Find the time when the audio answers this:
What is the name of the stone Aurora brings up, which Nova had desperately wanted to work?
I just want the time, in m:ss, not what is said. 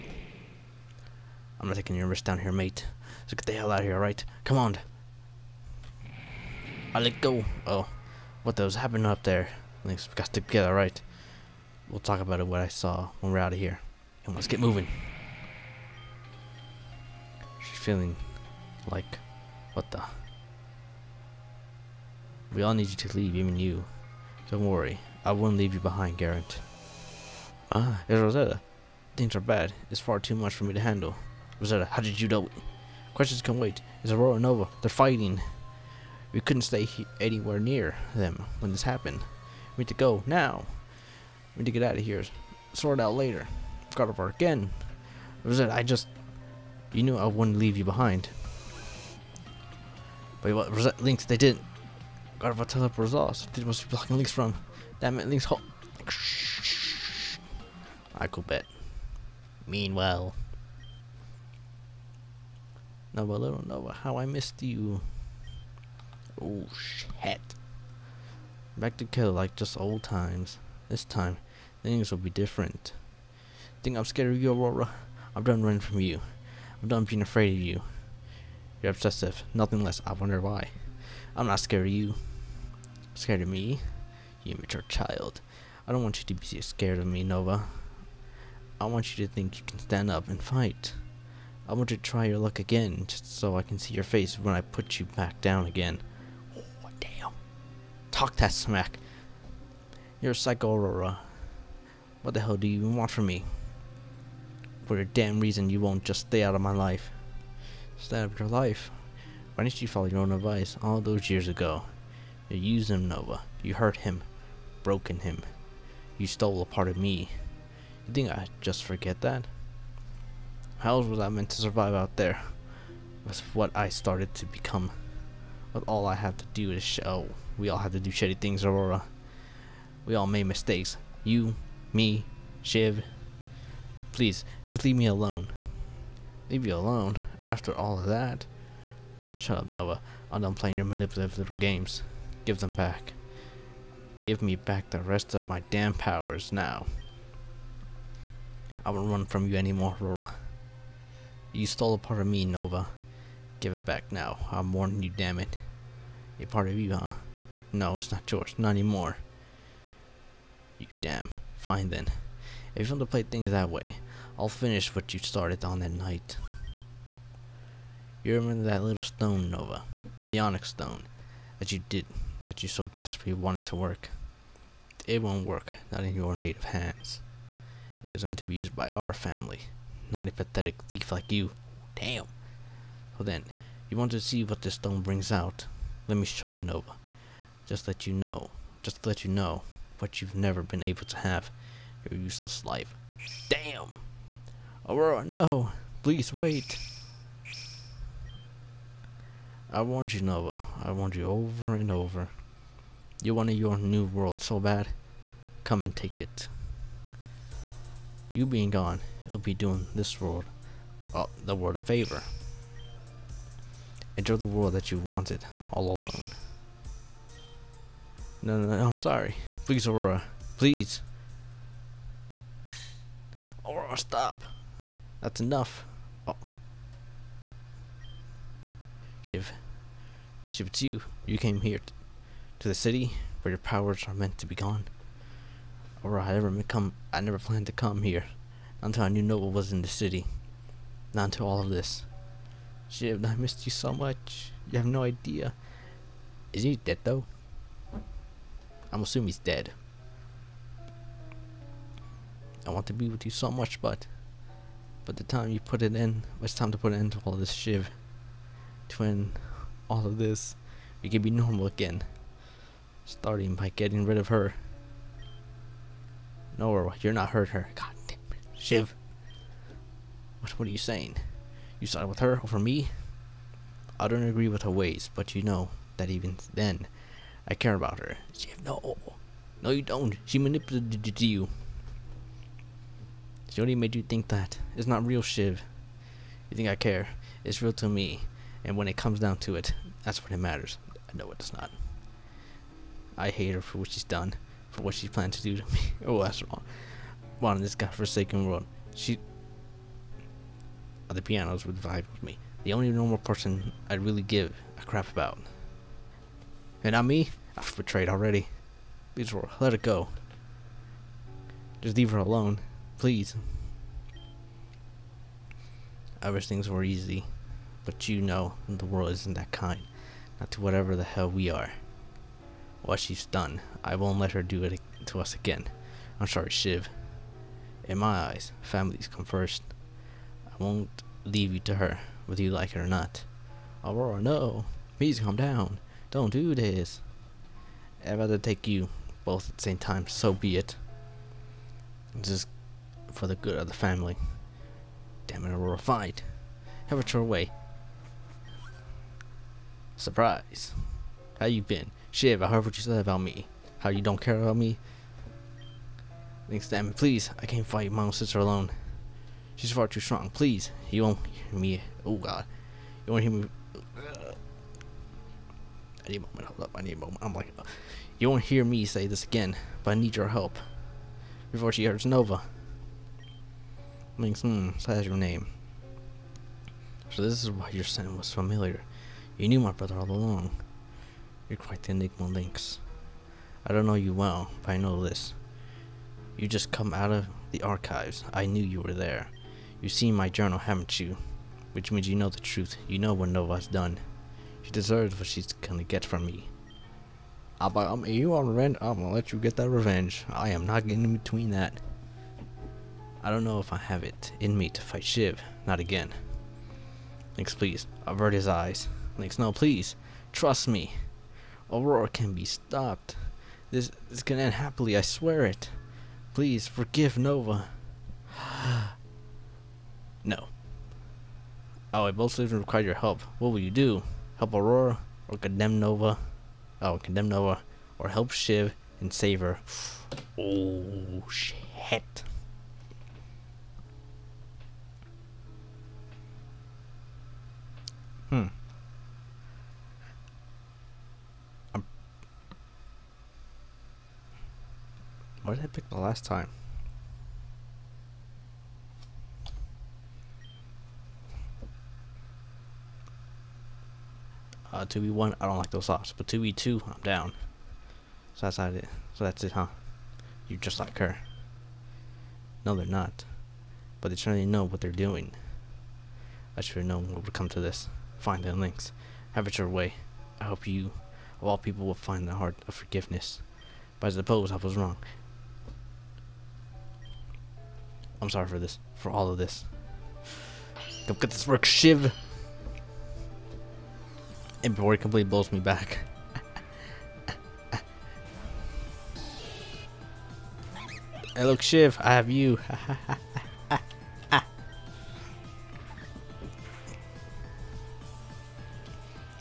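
2:50.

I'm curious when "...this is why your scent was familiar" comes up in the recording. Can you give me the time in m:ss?
6:17.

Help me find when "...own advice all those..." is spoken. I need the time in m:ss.
1:50.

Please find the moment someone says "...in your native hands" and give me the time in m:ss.
2:56.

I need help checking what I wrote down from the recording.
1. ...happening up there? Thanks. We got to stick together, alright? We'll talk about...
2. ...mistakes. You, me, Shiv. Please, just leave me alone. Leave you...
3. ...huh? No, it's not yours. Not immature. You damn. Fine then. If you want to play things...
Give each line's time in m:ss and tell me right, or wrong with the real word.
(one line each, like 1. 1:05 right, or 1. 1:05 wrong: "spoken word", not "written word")
1. 0:08 right
2. 2:10 right
3. 2:36 wrong: "anymore", not "immature".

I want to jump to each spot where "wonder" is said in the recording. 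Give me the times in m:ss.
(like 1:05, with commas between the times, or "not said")
1:20.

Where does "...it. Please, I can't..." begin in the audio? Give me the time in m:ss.
5:56.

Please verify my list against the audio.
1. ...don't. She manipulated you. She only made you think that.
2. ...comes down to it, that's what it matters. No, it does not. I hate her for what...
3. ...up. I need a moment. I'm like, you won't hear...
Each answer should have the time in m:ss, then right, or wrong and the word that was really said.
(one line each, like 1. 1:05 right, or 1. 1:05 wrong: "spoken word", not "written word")
1. 4:39 right
2. 4:48 right
3. 6:06 right.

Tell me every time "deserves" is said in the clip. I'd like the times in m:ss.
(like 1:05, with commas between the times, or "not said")
6:34.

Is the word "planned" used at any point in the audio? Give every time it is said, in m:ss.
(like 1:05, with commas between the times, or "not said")
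3:57, 4:55.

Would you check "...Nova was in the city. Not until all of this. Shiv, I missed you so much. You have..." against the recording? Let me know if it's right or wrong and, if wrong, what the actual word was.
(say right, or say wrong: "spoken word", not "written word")
right.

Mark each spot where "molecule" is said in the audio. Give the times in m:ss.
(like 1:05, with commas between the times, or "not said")
not said.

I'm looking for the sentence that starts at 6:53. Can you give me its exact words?
This is gonna end happily, I swear it.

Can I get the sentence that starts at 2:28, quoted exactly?
I won't run from you anymore, Aurora.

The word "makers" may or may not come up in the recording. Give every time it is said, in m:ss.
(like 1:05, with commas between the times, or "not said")
not said.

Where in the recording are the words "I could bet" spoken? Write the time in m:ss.
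0:58.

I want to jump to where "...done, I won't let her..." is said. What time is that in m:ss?
5:23.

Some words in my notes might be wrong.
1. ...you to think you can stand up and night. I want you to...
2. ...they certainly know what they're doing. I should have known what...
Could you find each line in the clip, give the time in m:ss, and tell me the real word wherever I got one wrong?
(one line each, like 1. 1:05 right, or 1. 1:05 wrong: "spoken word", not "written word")
1. 1:29 wrong: "fight", not "night"
2. 7:44 right.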